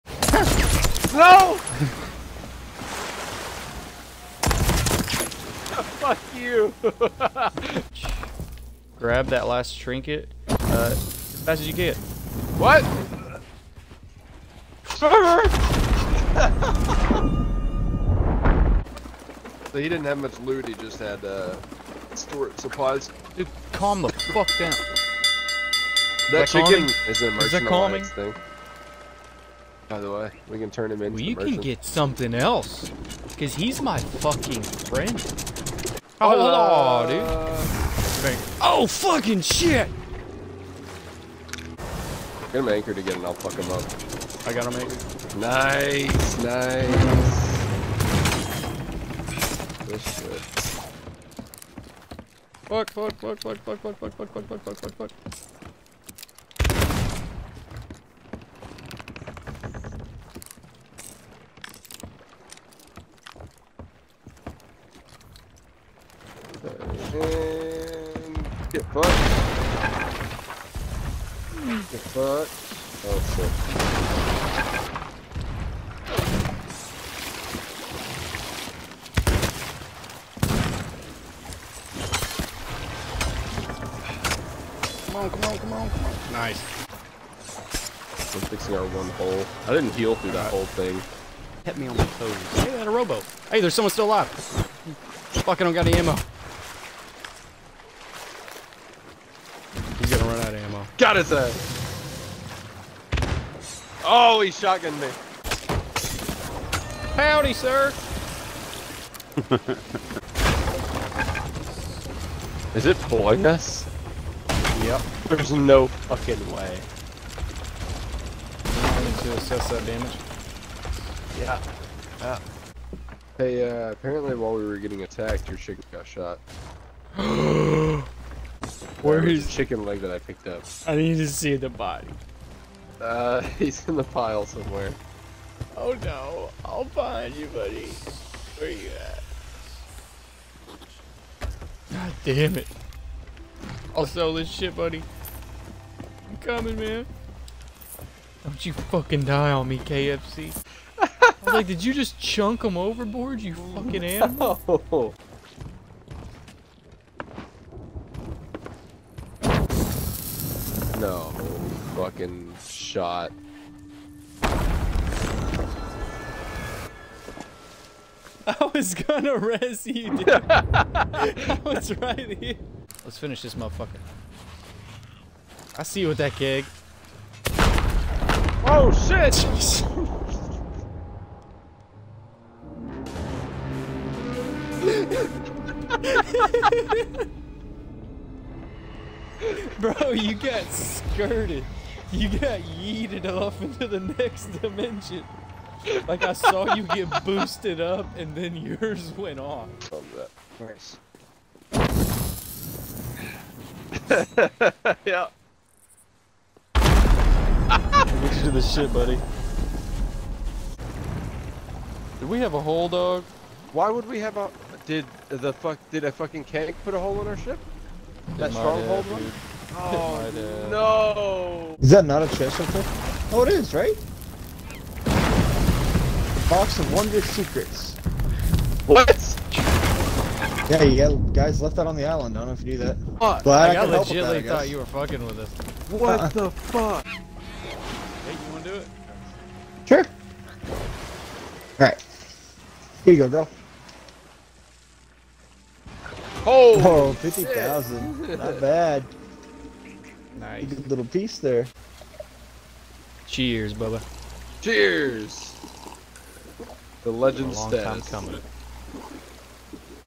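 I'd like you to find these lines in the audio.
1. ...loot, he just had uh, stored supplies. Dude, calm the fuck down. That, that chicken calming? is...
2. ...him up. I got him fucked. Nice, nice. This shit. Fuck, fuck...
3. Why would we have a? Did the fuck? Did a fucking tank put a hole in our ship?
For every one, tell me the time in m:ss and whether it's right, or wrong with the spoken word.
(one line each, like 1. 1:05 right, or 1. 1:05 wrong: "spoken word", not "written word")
1. 0:20 right
2. 0:43 wrong: "anchored", not "fucked"
3. 3:33 right.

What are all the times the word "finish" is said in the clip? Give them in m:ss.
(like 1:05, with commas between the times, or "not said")
2:53.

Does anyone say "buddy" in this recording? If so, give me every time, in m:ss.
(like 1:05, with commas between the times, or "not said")
2:17, 2:24, 3:28.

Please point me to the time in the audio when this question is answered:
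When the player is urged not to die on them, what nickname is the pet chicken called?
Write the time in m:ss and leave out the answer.
2:29.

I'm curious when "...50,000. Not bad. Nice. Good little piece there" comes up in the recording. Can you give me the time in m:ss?
4:07.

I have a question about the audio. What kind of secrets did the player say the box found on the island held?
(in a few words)
Wondrous secrets.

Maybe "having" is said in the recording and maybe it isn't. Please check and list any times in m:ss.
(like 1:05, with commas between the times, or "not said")
not said.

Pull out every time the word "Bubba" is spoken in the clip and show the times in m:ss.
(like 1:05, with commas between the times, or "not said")
4:13.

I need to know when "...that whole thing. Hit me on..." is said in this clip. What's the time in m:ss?
1:30.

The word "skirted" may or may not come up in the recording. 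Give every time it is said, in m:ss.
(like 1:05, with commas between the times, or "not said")
3:10.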